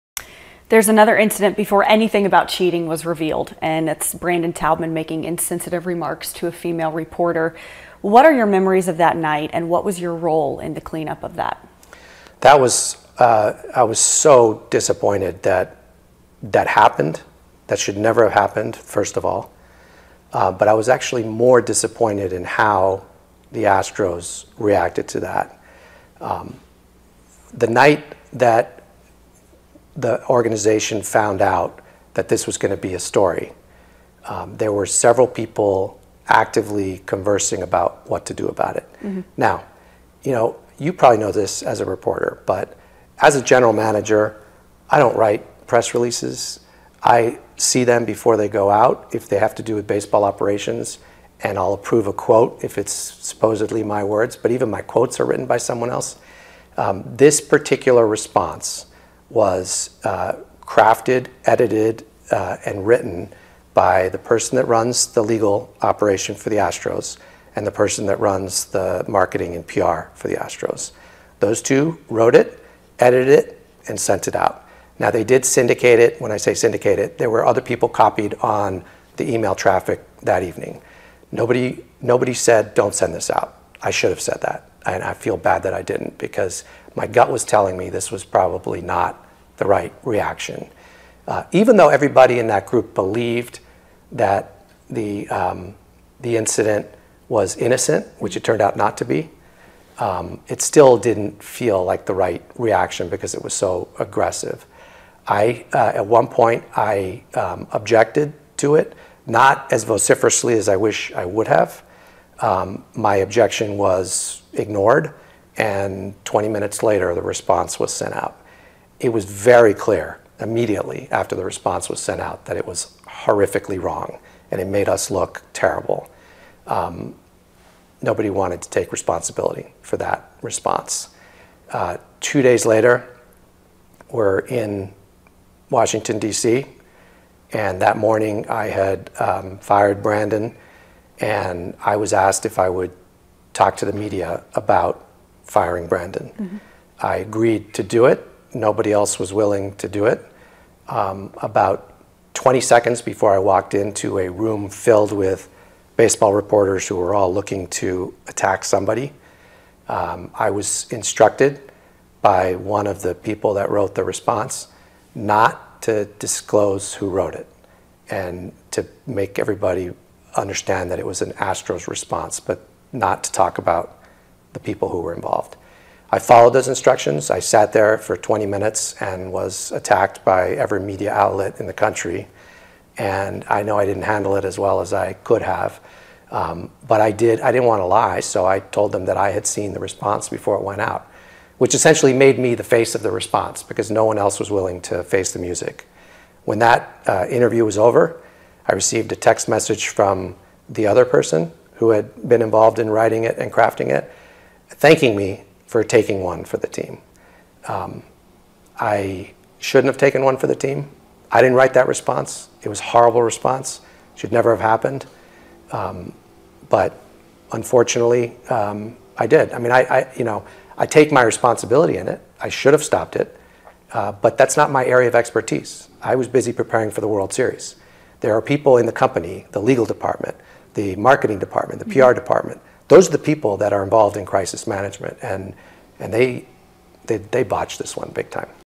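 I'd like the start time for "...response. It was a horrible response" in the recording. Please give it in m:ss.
3:31.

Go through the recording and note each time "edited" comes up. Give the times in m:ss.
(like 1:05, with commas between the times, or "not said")
1:01, 1:12.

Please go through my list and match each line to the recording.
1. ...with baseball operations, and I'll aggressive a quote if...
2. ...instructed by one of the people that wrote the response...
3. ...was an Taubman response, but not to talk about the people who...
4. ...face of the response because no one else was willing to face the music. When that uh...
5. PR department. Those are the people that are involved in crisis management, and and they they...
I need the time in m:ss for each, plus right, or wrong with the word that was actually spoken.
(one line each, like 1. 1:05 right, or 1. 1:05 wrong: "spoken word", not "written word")
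1. 0:49 wrong: "approve", not "aggressive"
2. 2:40 right
3. 2:51 wrong: "Astros", not "Taubman"
4. 3:12 right
5. 3:52 right.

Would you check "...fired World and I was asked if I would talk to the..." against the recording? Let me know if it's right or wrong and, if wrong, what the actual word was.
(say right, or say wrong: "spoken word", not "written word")
wrong: "Brandon", not "World".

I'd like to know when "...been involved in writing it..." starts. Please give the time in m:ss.
3:22.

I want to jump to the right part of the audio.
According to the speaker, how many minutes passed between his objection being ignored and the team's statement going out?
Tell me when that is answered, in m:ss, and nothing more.
1:56.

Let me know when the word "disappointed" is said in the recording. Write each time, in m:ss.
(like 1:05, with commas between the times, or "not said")
0:14, 0:21.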